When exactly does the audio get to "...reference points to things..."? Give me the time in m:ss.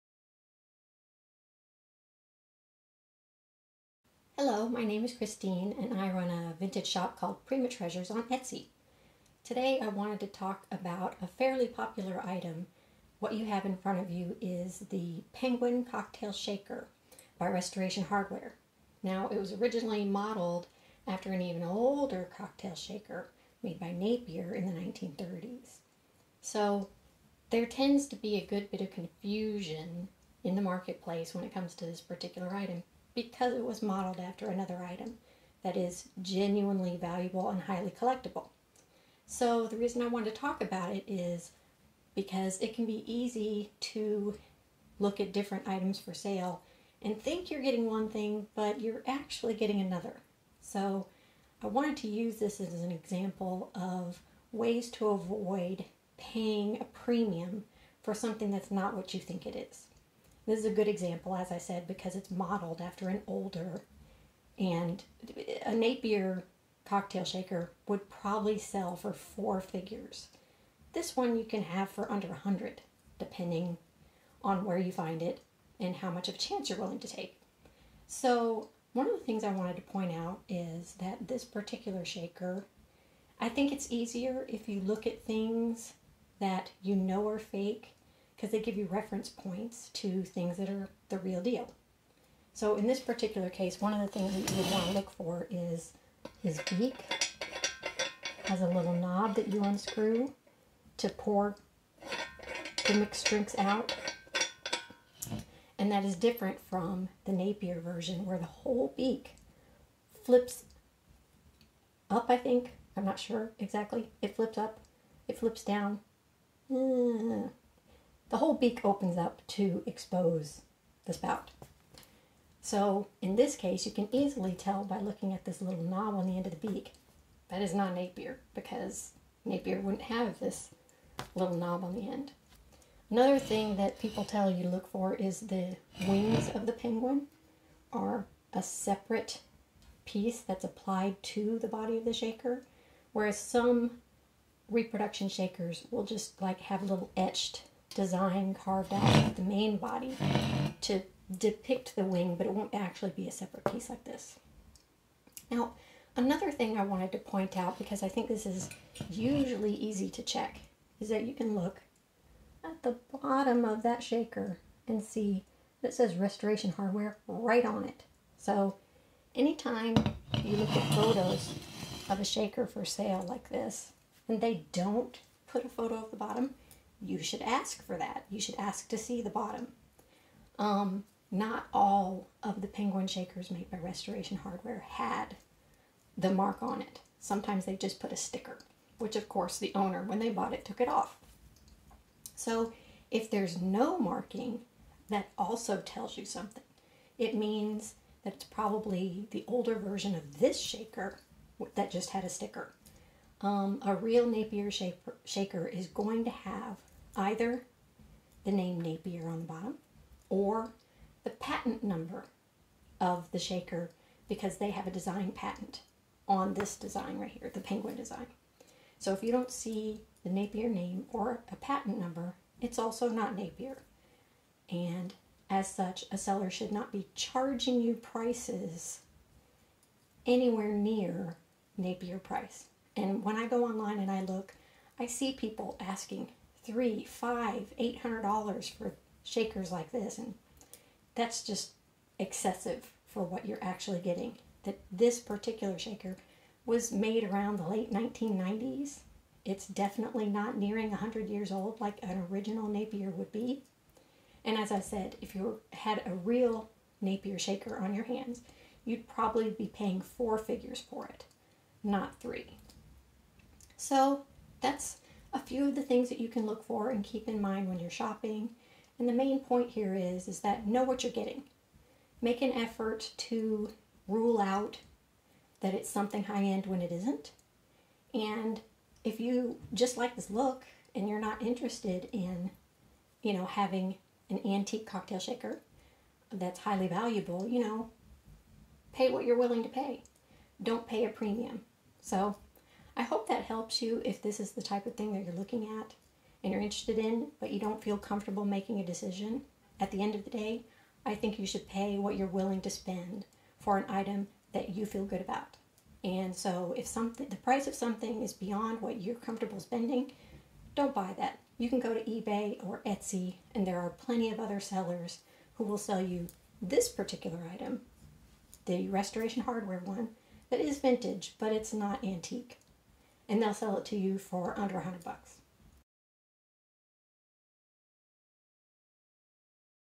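1:28.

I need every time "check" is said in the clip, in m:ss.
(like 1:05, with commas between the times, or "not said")
2:40.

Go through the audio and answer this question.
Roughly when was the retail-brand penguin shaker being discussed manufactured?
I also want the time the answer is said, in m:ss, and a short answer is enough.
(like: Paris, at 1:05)
late 1990s, at 4:07.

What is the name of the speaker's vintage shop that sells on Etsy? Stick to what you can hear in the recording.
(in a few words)
Prima Treasures.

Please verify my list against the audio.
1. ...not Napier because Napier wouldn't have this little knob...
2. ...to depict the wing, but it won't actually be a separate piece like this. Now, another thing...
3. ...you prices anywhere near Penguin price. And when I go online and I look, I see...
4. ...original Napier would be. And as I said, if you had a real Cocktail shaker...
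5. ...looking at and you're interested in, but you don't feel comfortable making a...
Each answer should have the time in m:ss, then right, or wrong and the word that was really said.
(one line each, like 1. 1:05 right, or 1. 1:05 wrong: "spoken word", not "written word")
1. 2:07 right
2. 2:30 right
3. 3:47 wrong: "Napier", not "Penguin"
4. 4:12 wrong: "Napier", not "Cocktail"
5. 4:55 right.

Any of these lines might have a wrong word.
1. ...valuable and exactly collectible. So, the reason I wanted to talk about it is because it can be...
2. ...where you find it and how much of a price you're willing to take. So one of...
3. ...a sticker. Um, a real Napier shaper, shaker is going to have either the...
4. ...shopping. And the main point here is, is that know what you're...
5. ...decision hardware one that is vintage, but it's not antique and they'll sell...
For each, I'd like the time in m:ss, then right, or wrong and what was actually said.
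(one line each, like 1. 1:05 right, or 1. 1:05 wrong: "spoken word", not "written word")
1. 0:36 wrong: "highly", not "exactly"
2. 1:14 wrong: "chance", not "price"
3. 3:22 right
4. 4:27 right
5. 5:18 wrong: "restoration", not "decision".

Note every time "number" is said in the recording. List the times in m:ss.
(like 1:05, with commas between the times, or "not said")
3:31, 3:41.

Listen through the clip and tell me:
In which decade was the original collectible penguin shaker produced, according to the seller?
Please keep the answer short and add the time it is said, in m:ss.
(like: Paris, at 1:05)
1930s, at 0:24.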